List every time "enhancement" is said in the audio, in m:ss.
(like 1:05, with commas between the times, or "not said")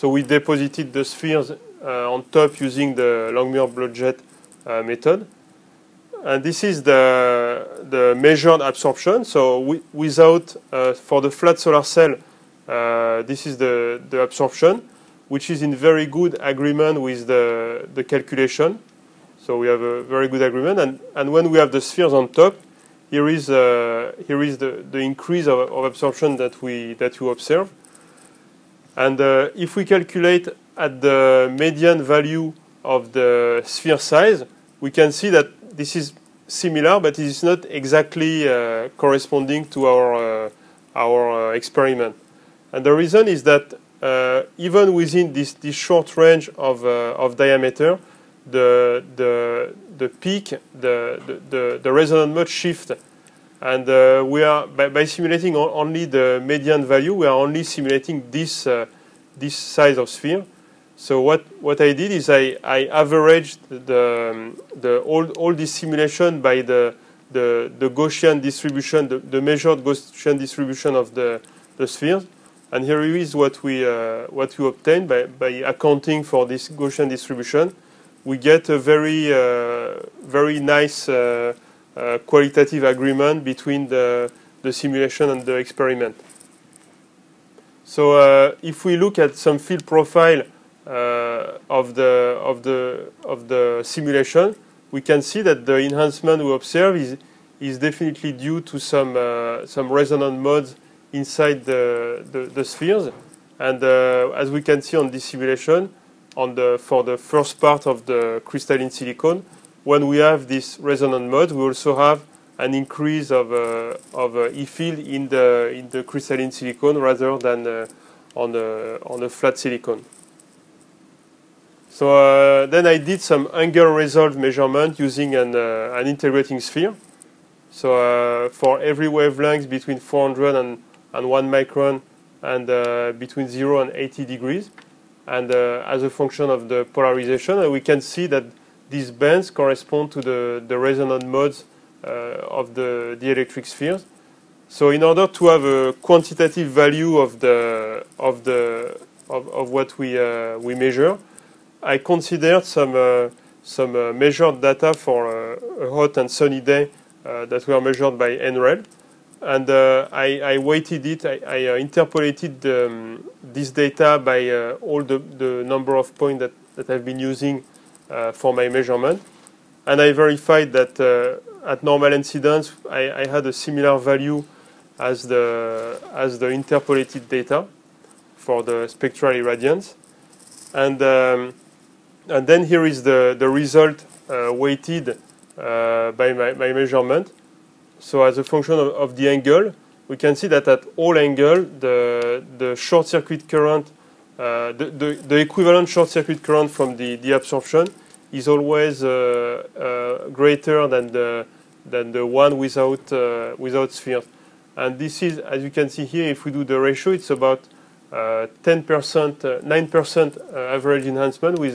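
1:35, 3:31.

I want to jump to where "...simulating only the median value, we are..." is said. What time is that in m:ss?
0:55.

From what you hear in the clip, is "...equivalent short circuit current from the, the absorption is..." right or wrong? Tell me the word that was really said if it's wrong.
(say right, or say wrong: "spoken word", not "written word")
right.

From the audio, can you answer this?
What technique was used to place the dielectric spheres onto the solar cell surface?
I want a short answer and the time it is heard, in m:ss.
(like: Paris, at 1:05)
Langmuir Blodgett method, at 0:03.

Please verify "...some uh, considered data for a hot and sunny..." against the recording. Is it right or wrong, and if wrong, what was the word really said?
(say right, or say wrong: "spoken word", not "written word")
wrong: "measured", not "considered".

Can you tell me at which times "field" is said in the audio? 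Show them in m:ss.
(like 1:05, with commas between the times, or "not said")
1:29, 1:54.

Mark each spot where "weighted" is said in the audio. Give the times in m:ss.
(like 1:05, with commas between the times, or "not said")
2:40, 3:04.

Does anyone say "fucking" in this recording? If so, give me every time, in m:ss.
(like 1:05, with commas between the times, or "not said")
not said.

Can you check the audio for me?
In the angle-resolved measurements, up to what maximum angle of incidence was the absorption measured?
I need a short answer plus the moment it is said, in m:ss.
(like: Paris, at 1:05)
80 degrees, at 2:13.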